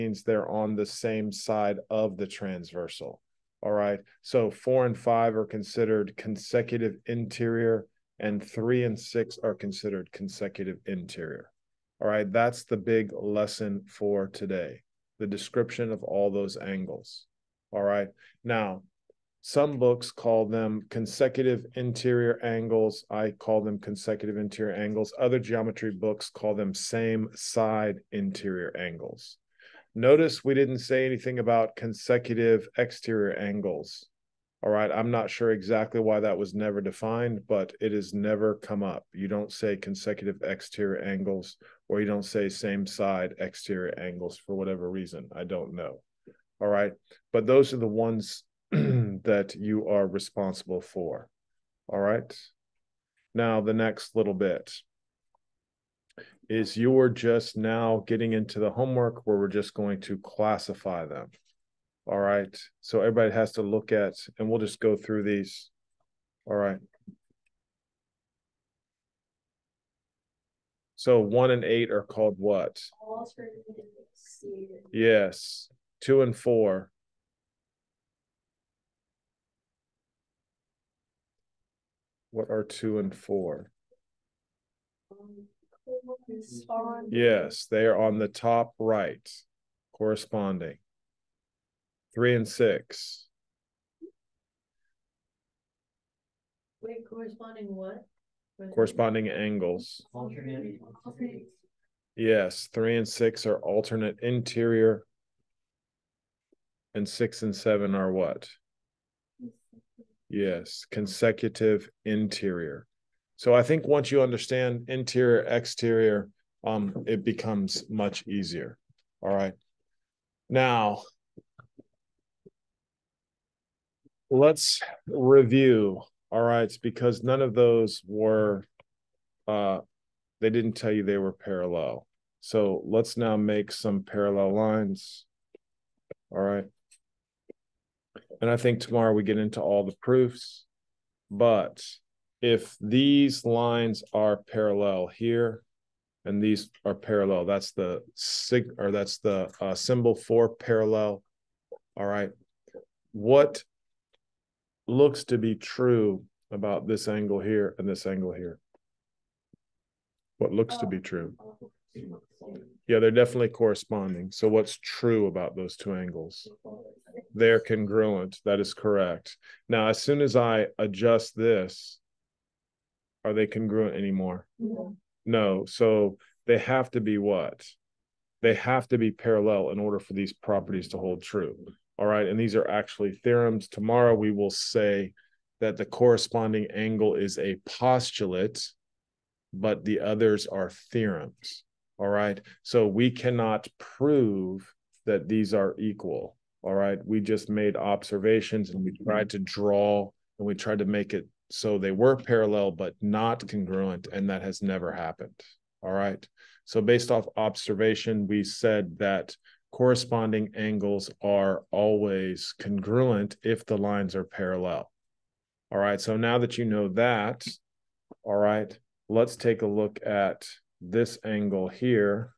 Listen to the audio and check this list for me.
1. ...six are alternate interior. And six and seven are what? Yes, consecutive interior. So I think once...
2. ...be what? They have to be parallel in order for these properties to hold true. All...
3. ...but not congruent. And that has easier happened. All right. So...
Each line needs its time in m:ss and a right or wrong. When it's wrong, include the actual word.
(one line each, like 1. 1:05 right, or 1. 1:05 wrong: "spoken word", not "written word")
1. 1:43 right
2. 2:57 right
3. 3:22 wrong: "never", not "easier".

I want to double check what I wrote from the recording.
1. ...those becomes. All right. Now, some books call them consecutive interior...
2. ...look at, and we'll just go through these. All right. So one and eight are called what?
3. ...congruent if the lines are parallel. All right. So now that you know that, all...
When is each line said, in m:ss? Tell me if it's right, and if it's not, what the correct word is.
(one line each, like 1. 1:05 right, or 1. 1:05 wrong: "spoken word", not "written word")
1. 0:16 wrong: "angles", not "becomes"
2. 1:03 right
3. 3:32 right.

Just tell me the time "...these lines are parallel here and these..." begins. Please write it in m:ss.
2:22.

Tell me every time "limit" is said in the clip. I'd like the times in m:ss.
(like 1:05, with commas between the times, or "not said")
not said.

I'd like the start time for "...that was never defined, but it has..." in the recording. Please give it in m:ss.
0:36.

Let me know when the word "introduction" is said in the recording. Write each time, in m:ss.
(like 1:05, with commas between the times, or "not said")
not said.